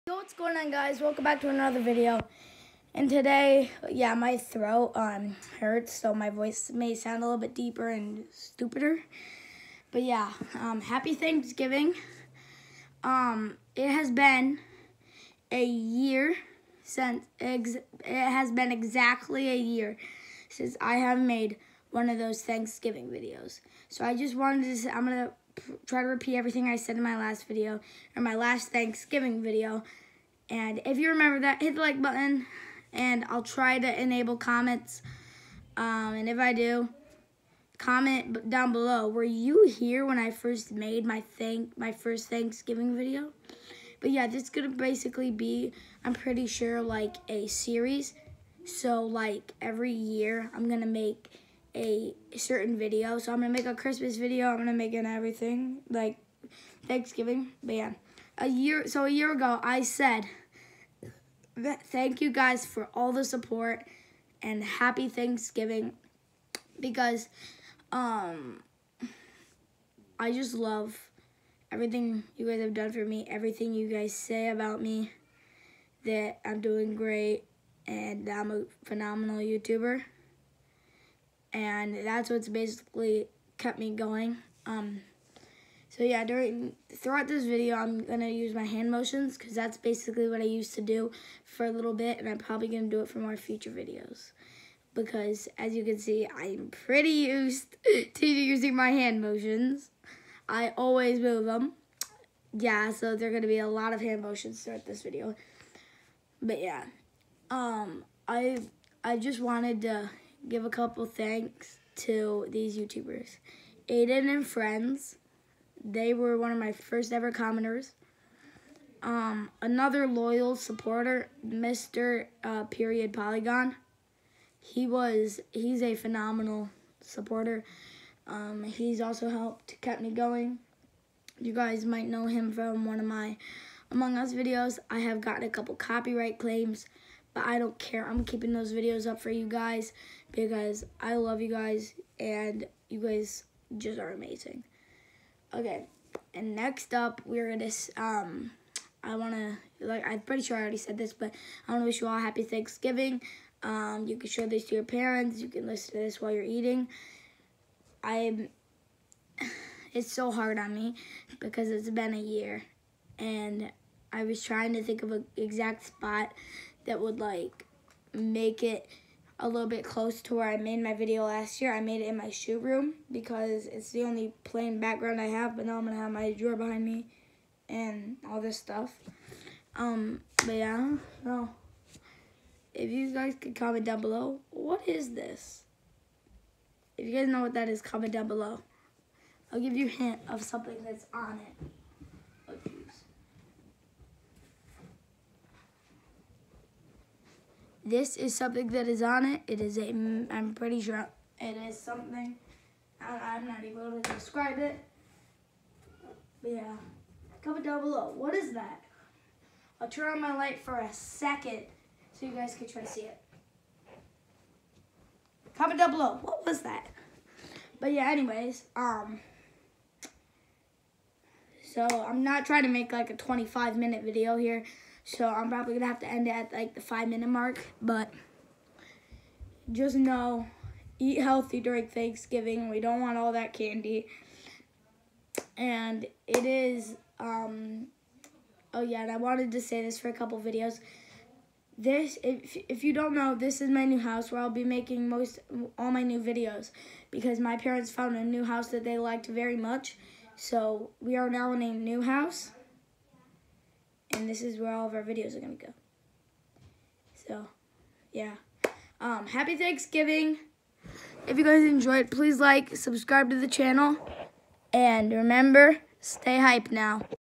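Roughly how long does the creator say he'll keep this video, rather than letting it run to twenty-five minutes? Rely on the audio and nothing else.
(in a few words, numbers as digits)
5 minutes.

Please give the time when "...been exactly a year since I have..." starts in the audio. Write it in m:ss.
0:18.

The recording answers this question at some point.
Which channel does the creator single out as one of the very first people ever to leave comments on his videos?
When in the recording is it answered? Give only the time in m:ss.
1:53.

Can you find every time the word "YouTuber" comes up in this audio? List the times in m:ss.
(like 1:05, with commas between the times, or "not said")
1:19, 1:52.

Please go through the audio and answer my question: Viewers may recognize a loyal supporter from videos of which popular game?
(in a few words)
Among Us.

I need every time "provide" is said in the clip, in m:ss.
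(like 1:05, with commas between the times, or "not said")
not said.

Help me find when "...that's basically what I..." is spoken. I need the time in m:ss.
1:29.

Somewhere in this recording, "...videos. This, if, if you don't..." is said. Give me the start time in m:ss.
4:00.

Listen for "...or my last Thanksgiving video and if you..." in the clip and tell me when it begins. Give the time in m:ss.
0:28.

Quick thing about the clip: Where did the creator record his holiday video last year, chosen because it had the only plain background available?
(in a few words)
shoe room.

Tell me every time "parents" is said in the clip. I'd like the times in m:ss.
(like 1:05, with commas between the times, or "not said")
2:34, 4:07.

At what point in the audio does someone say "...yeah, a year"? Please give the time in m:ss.
0:57.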